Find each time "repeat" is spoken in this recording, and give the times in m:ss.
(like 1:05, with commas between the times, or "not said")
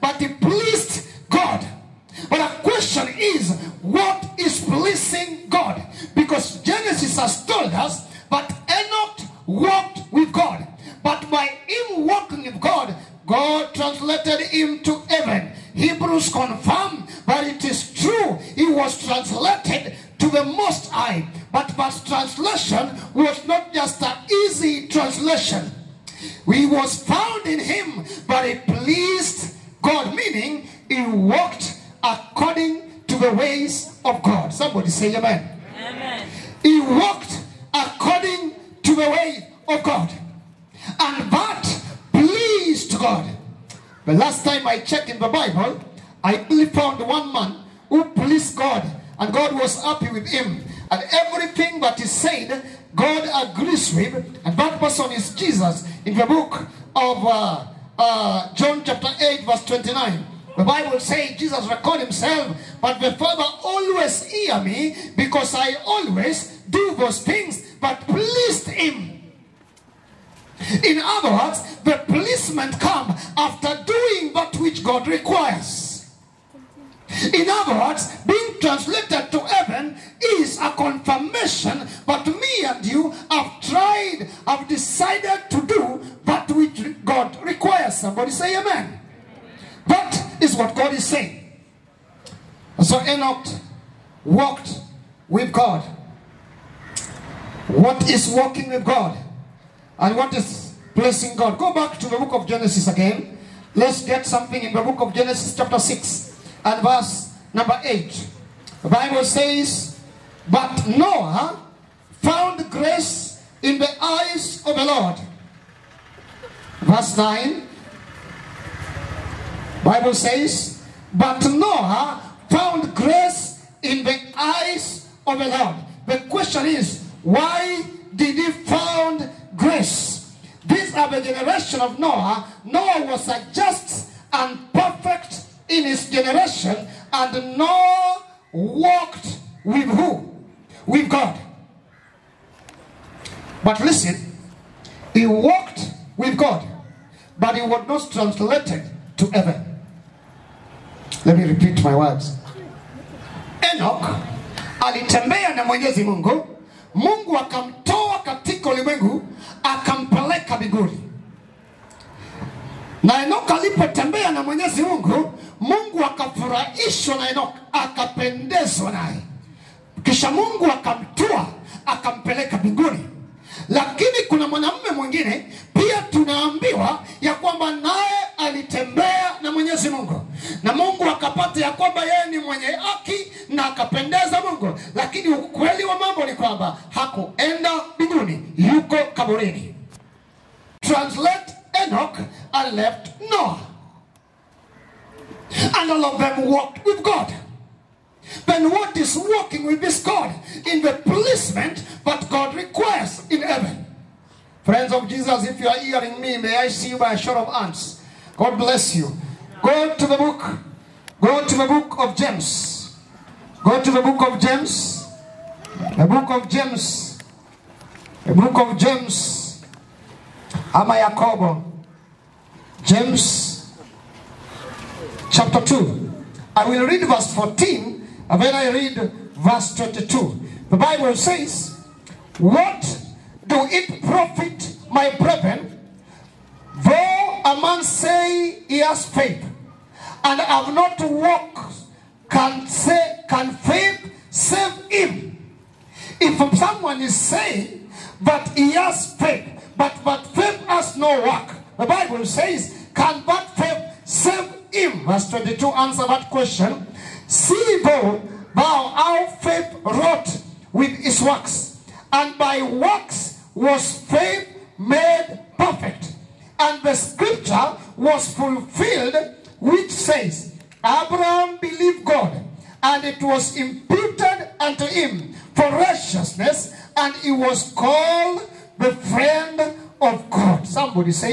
2:31.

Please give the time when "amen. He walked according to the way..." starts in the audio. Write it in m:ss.
0:35.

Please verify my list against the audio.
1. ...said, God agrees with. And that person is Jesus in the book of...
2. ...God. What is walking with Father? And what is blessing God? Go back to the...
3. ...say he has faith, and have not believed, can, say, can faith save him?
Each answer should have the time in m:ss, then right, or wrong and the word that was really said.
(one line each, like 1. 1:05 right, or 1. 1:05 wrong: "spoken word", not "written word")
1. 0:52 right
2. 1:35 wrong: "God", not "Father"
3. 3:57 wrong: "walked", not "believed".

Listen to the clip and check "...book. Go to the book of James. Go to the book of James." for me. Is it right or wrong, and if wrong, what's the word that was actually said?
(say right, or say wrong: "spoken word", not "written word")
right.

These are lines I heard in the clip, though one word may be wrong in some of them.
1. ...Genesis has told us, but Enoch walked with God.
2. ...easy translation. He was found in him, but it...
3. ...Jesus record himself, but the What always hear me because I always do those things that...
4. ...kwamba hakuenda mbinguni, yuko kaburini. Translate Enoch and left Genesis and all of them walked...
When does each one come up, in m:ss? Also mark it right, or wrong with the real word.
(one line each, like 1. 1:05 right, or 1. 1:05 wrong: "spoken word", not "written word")
1. 0:06 right
2. 0:24 right
3. 1:01 wrong: "Father", not "What"
4. 3:06 wrong: "Noah", not "Genesis".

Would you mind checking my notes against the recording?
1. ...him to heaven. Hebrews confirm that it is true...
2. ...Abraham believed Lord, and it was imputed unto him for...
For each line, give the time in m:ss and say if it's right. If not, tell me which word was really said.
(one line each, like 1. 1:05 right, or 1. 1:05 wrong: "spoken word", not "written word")
1. 0:14 right
2. 4:30 wrong: "God", not "Lord".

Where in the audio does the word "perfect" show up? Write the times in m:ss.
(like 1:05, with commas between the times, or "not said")
2:14, 4:25.